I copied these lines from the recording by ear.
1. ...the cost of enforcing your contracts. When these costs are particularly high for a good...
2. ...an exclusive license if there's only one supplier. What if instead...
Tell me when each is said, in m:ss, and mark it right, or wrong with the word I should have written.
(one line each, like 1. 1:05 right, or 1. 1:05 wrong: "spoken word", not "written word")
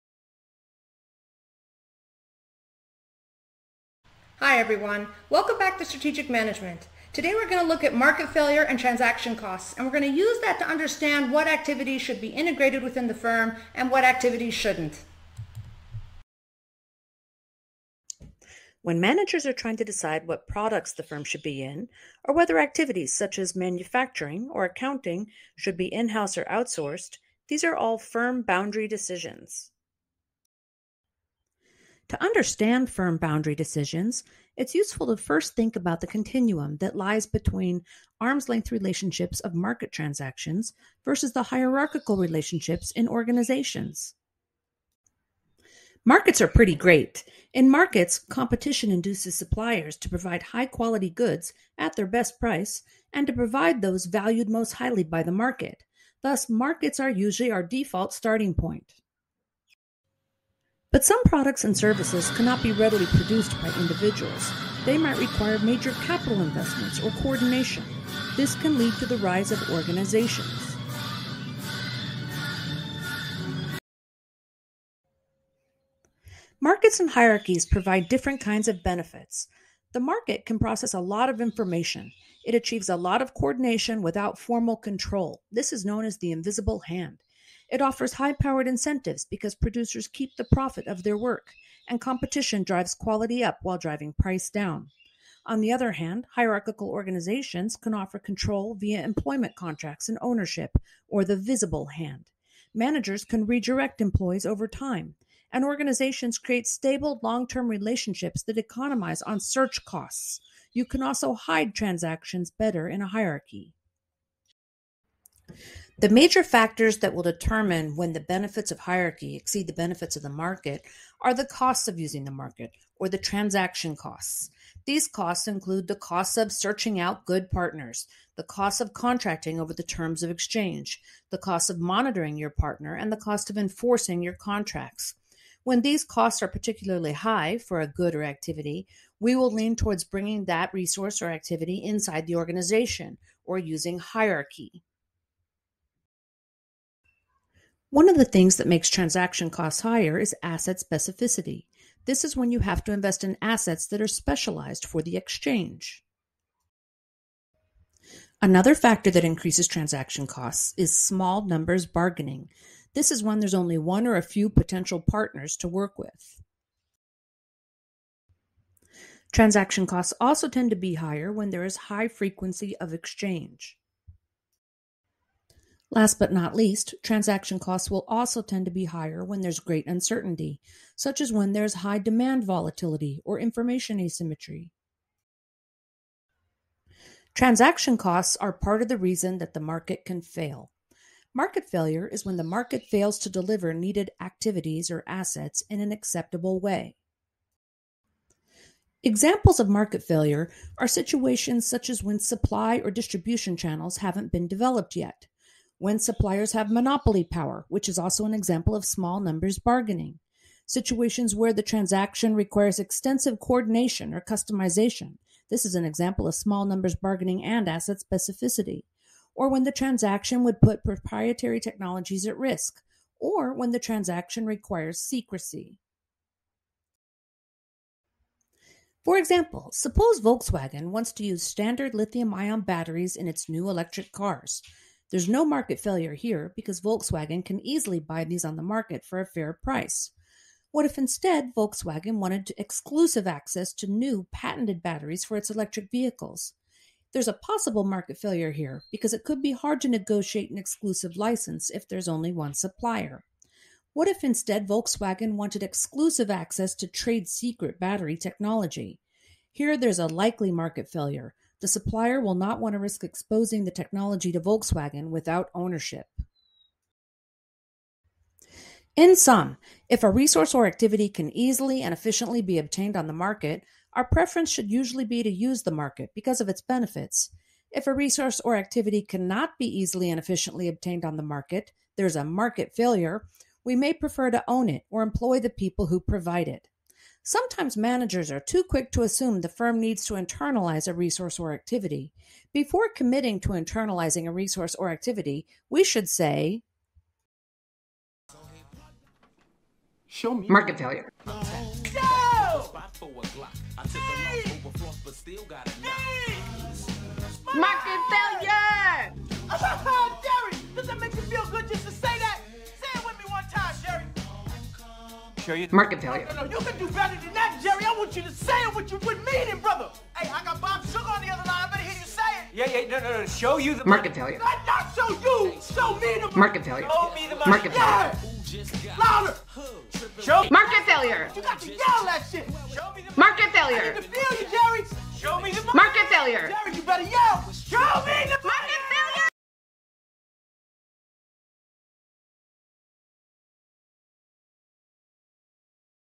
1. 2:13 right
2. 4:10 right.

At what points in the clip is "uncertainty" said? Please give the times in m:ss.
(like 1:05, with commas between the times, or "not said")
2:59.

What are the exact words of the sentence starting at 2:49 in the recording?
Transaction costs also tend to be higher when there is high frequency of exchange.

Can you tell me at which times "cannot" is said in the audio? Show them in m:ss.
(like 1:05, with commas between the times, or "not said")
1:02, 4:39.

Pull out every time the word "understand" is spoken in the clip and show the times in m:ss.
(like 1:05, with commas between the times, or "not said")
0:10, 0:32.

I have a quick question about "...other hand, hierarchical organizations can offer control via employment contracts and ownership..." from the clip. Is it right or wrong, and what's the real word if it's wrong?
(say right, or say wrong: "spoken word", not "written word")
right.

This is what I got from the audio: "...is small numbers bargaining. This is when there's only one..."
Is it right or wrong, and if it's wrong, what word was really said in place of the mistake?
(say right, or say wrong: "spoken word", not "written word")
right.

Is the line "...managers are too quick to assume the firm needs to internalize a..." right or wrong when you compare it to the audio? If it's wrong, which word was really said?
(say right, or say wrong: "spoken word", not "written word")
right.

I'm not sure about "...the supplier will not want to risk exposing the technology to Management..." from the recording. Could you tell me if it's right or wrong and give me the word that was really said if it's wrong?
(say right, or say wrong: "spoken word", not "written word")
wrong: "Volkswagen", not "Management".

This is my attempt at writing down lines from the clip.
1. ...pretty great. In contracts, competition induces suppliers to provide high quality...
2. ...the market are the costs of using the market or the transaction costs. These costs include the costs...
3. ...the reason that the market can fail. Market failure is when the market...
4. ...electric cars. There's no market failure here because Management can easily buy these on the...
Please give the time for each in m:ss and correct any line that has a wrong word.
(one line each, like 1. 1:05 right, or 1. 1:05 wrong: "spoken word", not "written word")
1. 0:46 wrong: "markets", not "contracts"
2. 2:00 right
3. 3:08 right
4. 3:53 wrong: "Volkswagen", not "Management".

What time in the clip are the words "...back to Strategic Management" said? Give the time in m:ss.
0:05.